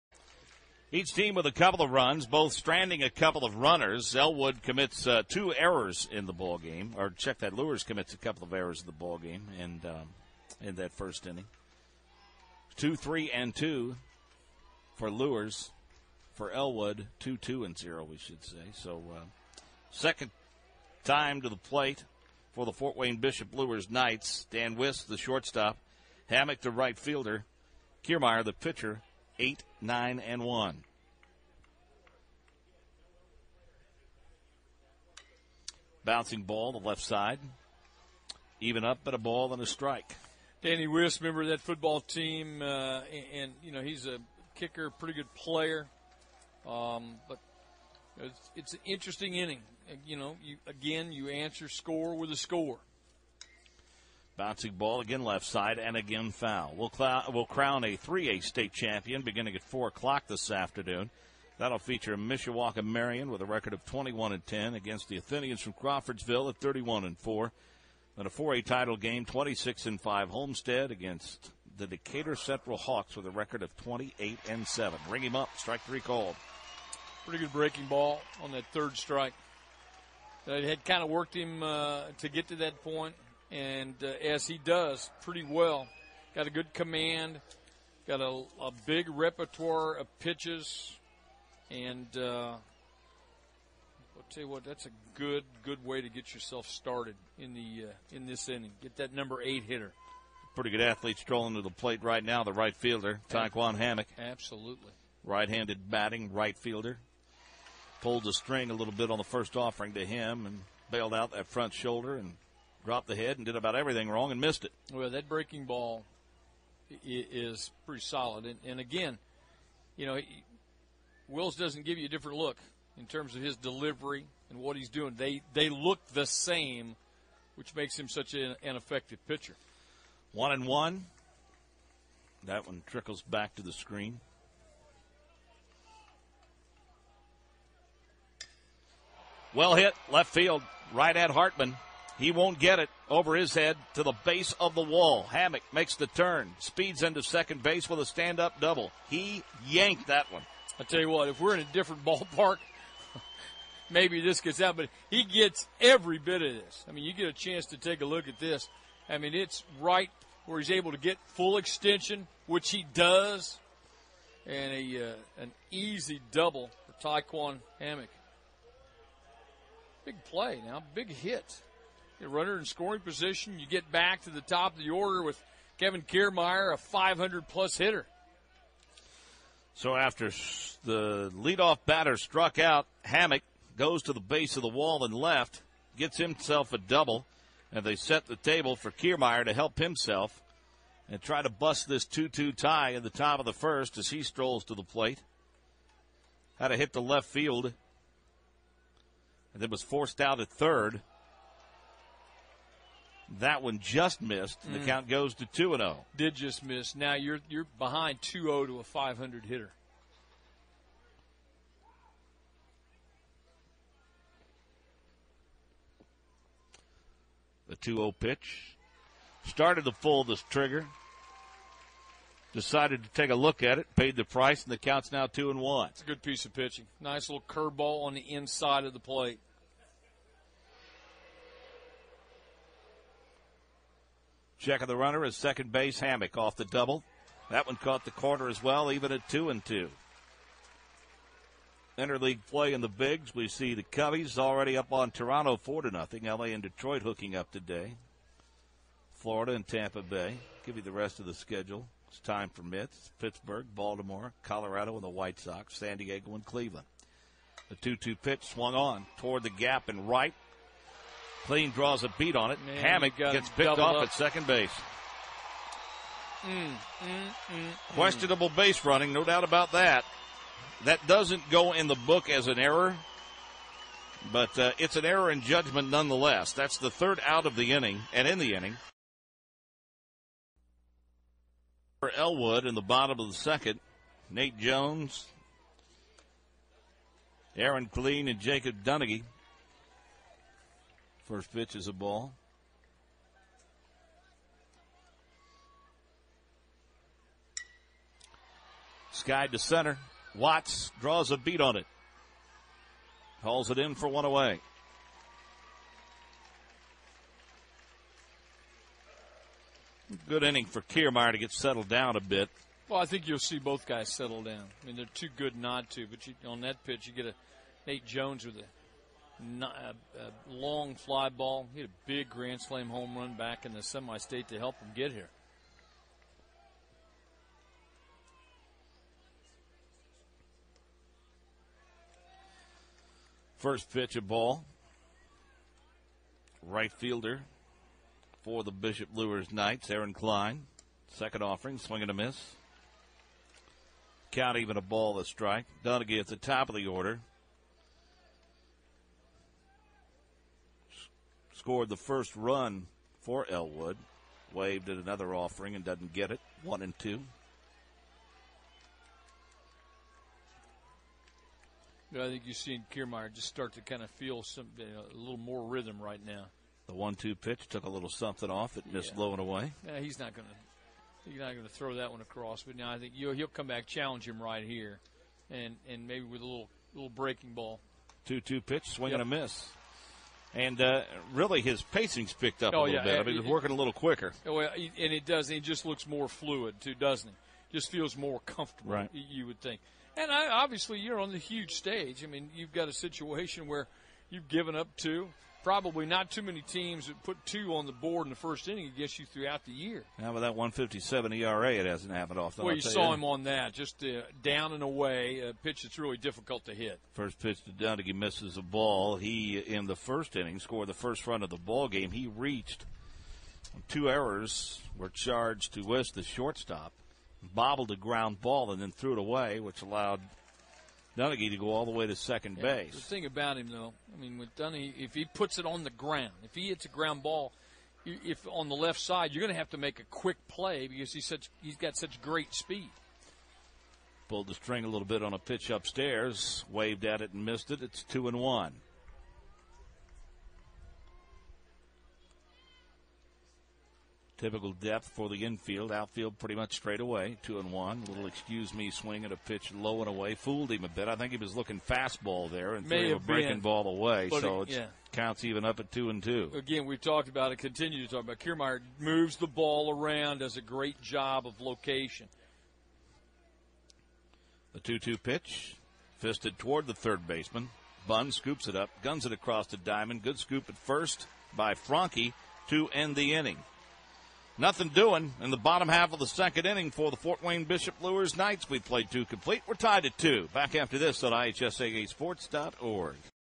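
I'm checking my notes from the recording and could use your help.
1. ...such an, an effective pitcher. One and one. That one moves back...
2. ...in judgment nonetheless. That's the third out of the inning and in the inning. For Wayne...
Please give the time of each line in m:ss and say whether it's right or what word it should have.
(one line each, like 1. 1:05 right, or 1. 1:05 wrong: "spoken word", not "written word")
1. 2:08 wrong: "trickles", not "moves"
2. 4:35 wrong: "Elwood", not "Wayne".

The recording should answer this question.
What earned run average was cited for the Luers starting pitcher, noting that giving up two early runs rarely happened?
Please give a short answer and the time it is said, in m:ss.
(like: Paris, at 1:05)
1.57, at 6:40.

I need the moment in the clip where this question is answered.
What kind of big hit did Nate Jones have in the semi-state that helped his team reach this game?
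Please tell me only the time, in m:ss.
5:22.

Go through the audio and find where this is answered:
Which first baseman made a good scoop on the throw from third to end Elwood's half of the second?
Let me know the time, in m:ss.
7:51.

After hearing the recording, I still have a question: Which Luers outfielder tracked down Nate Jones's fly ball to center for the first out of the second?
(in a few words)
Watts.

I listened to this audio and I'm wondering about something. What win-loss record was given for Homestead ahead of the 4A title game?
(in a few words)
26 and 5.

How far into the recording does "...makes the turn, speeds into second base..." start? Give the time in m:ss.
2:25.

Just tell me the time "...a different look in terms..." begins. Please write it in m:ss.
2:02.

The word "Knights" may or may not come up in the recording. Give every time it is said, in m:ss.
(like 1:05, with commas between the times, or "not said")
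0:23, 5:39, 7:58.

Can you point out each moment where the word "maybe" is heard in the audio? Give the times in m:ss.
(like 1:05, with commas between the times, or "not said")
2:33, 6:16.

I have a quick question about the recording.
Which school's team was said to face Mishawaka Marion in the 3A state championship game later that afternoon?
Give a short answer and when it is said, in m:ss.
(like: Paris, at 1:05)
Crawfordsville, at 1:05.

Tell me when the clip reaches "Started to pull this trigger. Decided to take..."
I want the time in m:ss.
3:39.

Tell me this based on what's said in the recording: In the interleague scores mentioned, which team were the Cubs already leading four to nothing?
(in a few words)
Toronto.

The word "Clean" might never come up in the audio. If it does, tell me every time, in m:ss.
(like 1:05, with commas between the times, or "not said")
4:21, 4:47.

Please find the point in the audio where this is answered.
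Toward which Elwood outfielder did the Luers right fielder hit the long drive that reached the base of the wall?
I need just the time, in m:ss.
2:21.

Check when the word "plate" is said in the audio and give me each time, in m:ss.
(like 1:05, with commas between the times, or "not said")
0:21, 1:41, 3:14, 3:48.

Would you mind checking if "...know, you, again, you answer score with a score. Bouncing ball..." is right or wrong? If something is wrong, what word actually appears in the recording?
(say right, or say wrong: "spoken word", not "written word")
right.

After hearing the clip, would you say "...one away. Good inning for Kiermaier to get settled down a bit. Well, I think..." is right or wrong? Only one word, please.
right.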